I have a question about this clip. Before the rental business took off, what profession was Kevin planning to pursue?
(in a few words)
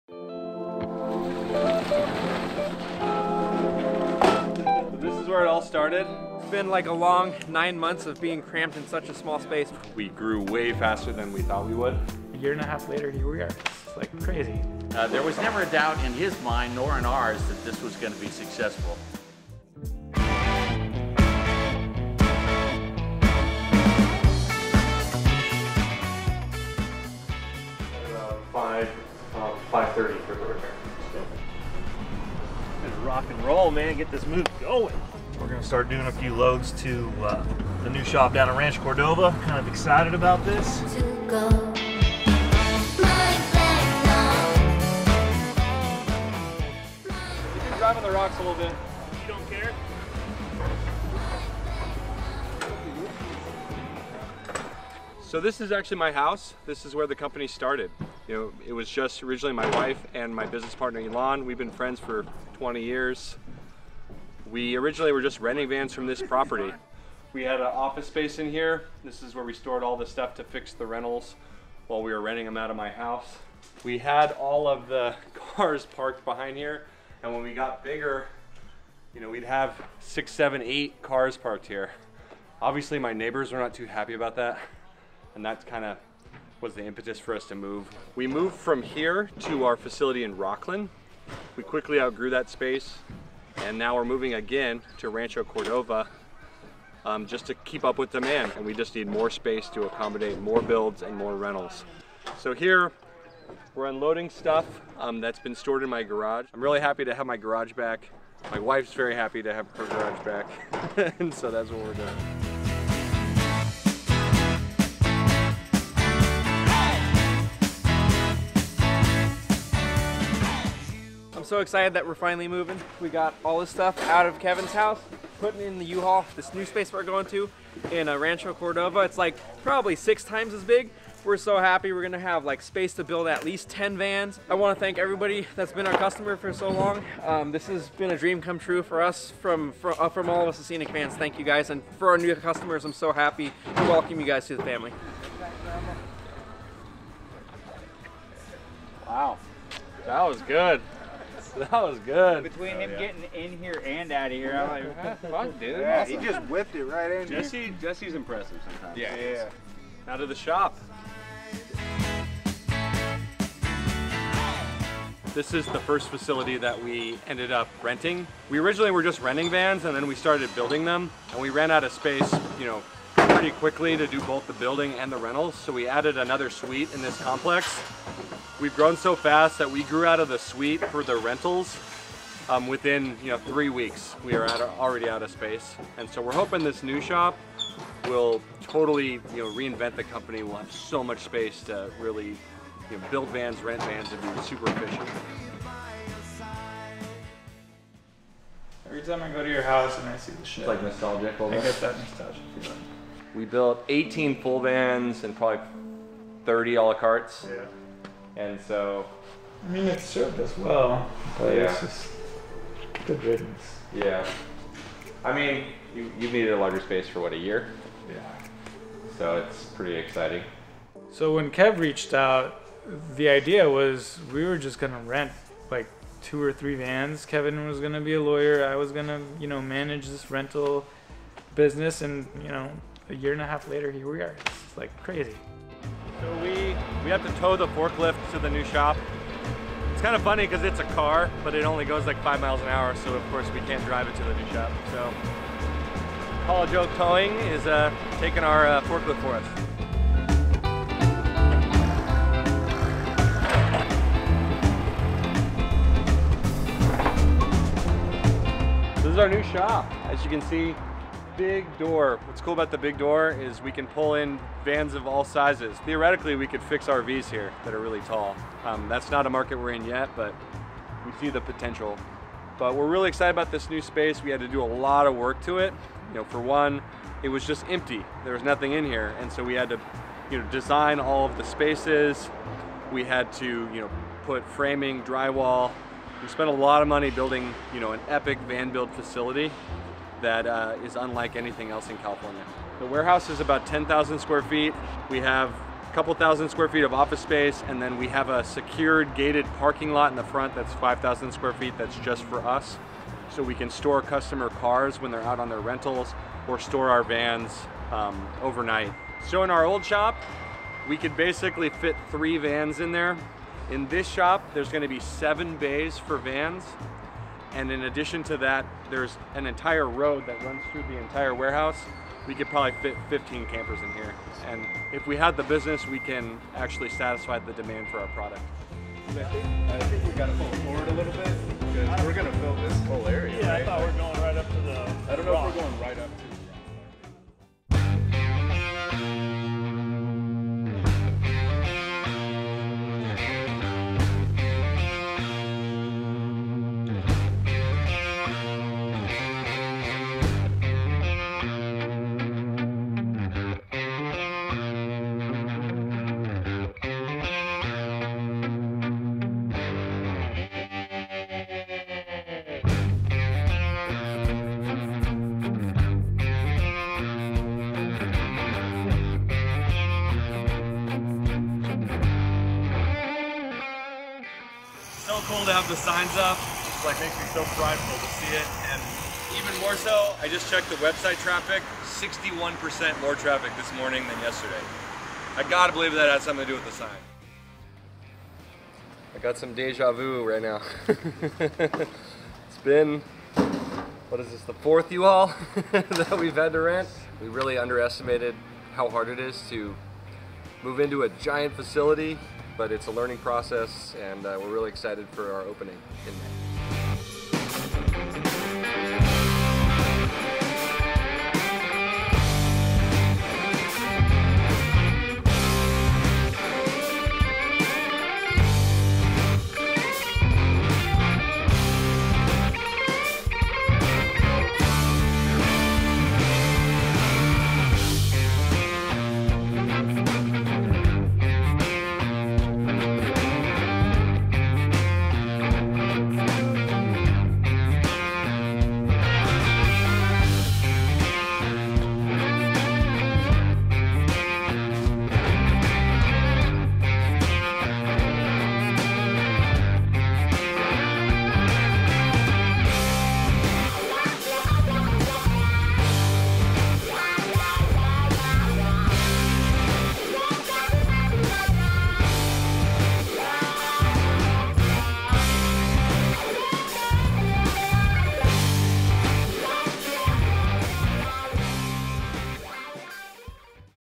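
Lawyer.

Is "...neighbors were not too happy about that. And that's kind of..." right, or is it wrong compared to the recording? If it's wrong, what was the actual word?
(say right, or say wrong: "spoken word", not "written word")
right.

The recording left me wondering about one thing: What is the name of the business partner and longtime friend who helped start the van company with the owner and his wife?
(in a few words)
Elon.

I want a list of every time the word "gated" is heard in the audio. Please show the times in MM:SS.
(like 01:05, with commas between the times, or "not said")
04:59.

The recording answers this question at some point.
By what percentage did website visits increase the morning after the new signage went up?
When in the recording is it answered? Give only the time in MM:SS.
06:21.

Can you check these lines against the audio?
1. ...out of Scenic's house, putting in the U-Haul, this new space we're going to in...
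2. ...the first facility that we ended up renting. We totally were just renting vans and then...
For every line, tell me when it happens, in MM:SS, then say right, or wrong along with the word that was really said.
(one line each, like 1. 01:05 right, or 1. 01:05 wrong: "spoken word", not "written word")
1. 02:04 wrong: "Kevin", not "Scenic"
2. 02:45 wrong: "originally", not "totally".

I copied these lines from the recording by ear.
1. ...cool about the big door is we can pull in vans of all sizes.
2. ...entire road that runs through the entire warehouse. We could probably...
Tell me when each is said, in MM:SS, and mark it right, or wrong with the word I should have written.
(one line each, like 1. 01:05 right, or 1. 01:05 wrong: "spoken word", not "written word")
1. 04:22 right
2. 05:19 right.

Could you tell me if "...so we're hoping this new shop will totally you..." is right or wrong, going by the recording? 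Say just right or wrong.
right.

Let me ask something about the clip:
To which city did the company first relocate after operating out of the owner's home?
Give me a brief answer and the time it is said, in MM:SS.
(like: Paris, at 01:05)
Rocklin, at 01:30.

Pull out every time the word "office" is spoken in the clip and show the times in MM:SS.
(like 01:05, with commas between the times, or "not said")
01:07, 04:56.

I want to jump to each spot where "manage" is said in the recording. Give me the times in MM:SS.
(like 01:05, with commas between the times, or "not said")
03:49.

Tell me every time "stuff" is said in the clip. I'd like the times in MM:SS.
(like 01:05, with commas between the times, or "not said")
01:10, 01:44, 02:03.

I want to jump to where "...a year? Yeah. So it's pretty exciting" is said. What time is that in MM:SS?
03:37.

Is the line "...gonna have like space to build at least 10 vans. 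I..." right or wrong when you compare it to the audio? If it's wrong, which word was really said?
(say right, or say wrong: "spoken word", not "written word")
right.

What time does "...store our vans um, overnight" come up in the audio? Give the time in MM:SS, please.
05:06.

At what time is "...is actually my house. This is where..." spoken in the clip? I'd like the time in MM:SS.
00:55.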